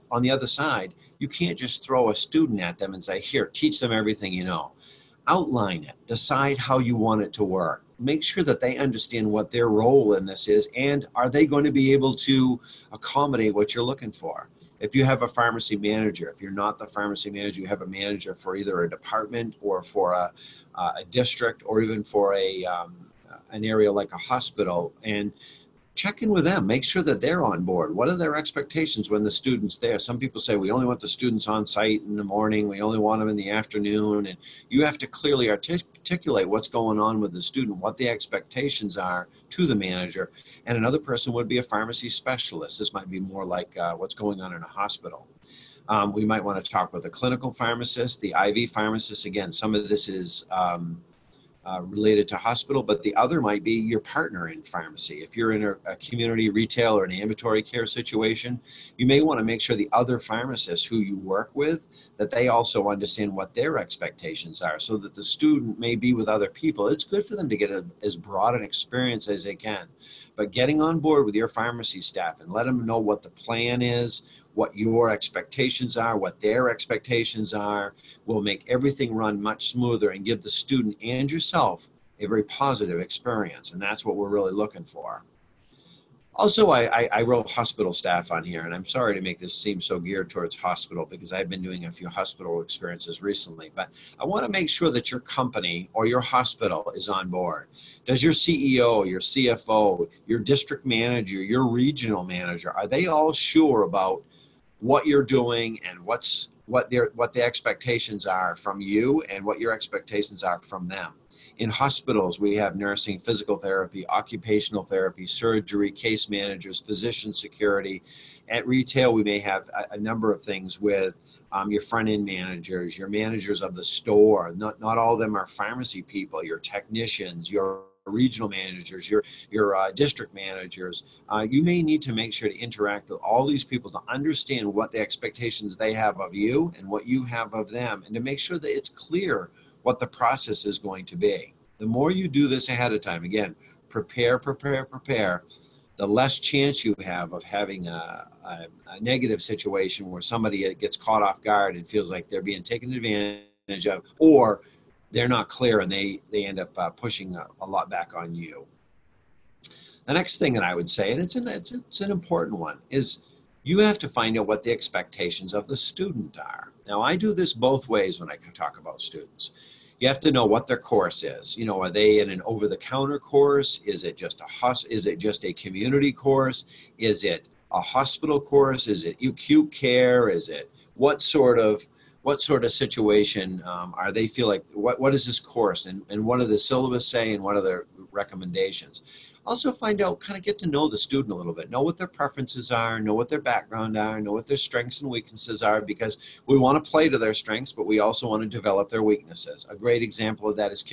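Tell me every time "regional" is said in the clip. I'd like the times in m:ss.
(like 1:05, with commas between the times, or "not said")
1:41, 2:08.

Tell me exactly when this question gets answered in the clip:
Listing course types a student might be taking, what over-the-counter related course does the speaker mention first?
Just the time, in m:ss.
2:52.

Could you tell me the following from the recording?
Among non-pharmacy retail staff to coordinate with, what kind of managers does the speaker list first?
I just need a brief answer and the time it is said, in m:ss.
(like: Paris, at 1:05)
Front end managers, at 2:01.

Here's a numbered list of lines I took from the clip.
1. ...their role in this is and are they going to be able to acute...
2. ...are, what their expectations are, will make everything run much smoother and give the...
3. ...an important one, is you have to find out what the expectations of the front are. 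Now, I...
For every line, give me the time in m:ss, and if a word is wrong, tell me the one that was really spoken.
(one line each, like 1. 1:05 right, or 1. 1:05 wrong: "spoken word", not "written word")
1. 0:09 wrong: "accommodate", not "acute"
2. 1:15 right
3. 2:42 wrong: "student", not "front".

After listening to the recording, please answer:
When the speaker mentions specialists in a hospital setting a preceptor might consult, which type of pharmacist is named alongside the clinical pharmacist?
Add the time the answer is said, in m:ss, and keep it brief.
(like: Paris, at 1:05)
IV pharmacist, at 0:48.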